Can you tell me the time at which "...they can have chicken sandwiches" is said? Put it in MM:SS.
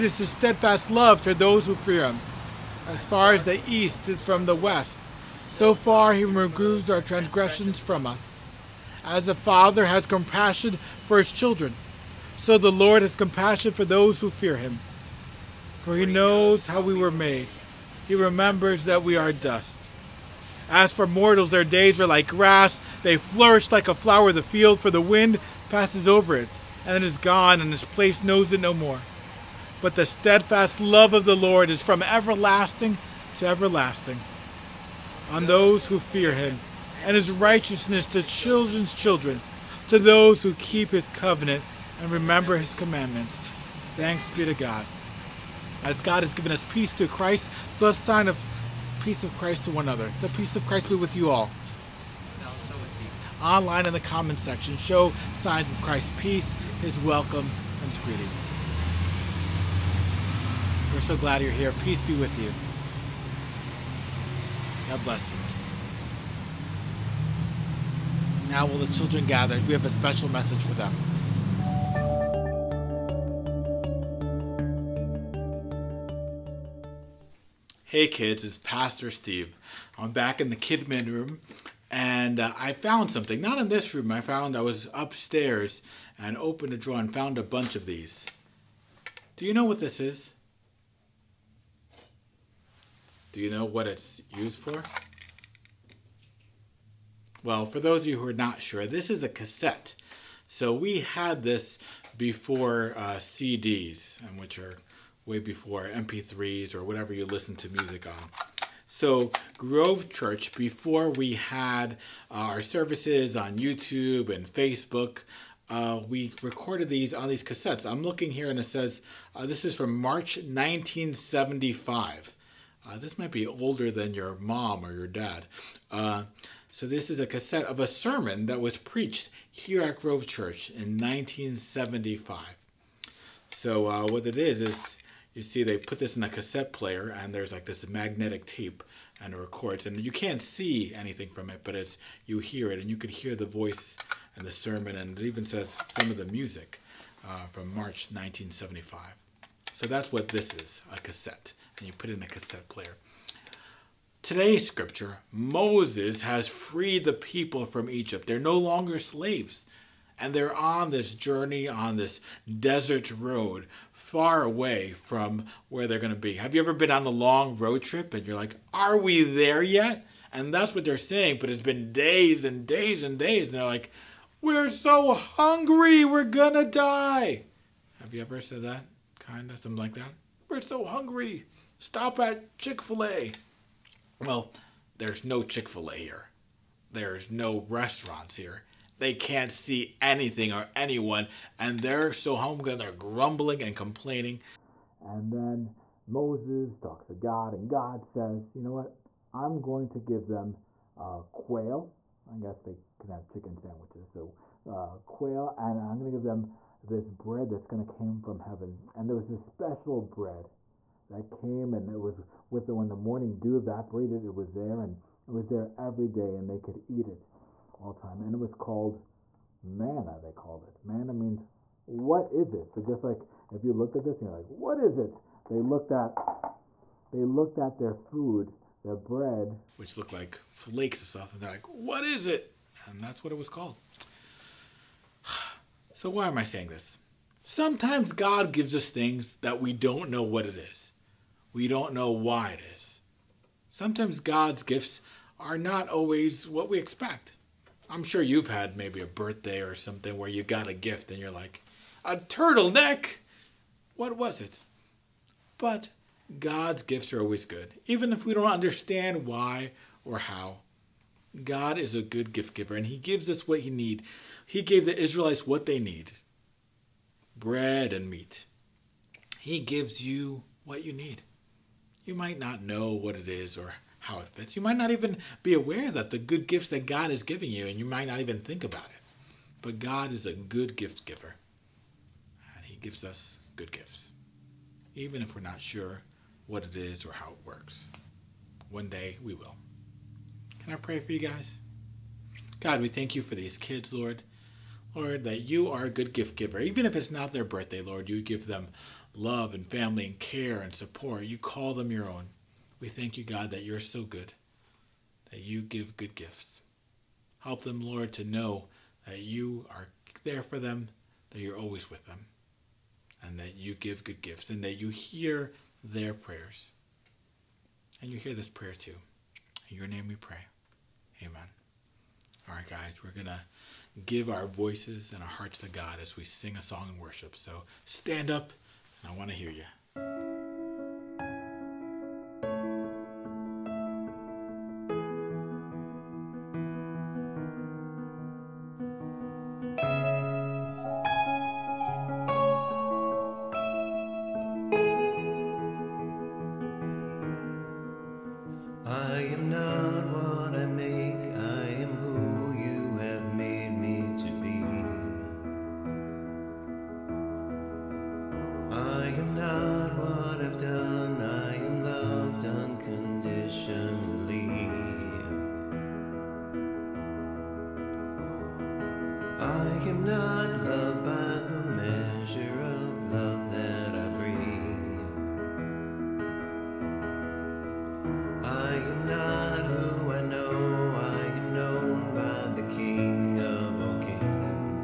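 03:22.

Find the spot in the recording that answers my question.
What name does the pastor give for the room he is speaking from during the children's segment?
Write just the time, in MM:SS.
01:20.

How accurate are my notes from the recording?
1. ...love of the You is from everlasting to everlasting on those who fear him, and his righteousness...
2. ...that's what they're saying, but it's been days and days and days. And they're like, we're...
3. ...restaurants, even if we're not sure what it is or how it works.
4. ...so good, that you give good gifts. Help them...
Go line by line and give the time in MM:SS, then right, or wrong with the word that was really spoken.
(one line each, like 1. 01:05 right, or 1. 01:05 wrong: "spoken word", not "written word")
1. 00:30 wrong: "Lord", not "You"
2. 02:50 right
3. 04:43 wrong: "gifts", not "restaurants"
4. 05:03 right.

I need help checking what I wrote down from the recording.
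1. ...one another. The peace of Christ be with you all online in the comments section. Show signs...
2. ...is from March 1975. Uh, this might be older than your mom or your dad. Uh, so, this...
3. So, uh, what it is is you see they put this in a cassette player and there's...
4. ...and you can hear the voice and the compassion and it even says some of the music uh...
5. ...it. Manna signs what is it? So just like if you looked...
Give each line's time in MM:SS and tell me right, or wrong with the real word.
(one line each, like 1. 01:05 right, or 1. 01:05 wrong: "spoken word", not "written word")
1. 00:49 right
2. 01:59 right
3. 02:13 right
4. 02:22 wrong: "sermon", not "compassion"
5. 03:40 wrong: "means", not "signs".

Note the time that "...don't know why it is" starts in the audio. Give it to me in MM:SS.
04:01.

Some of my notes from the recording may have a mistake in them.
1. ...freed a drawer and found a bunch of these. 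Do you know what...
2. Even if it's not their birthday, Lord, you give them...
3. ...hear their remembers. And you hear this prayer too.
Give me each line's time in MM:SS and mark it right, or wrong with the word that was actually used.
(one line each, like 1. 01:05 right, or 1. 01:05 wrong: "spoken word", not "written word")
1. 01:26 wrong: "opened", not "freed"
2. 04:56 right
3. 05:14 wrong: "prayers", not "remembers".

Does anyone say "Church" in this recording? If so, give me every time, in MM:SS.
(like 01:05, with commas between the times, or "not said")
01:50, 02:10.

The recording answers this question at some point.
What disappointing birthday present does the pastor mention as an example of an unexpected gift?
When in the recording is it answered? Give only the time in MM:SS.
04:12.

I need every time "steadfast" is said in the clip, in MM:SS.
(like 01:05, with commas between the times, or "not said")
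00:00, 00:30.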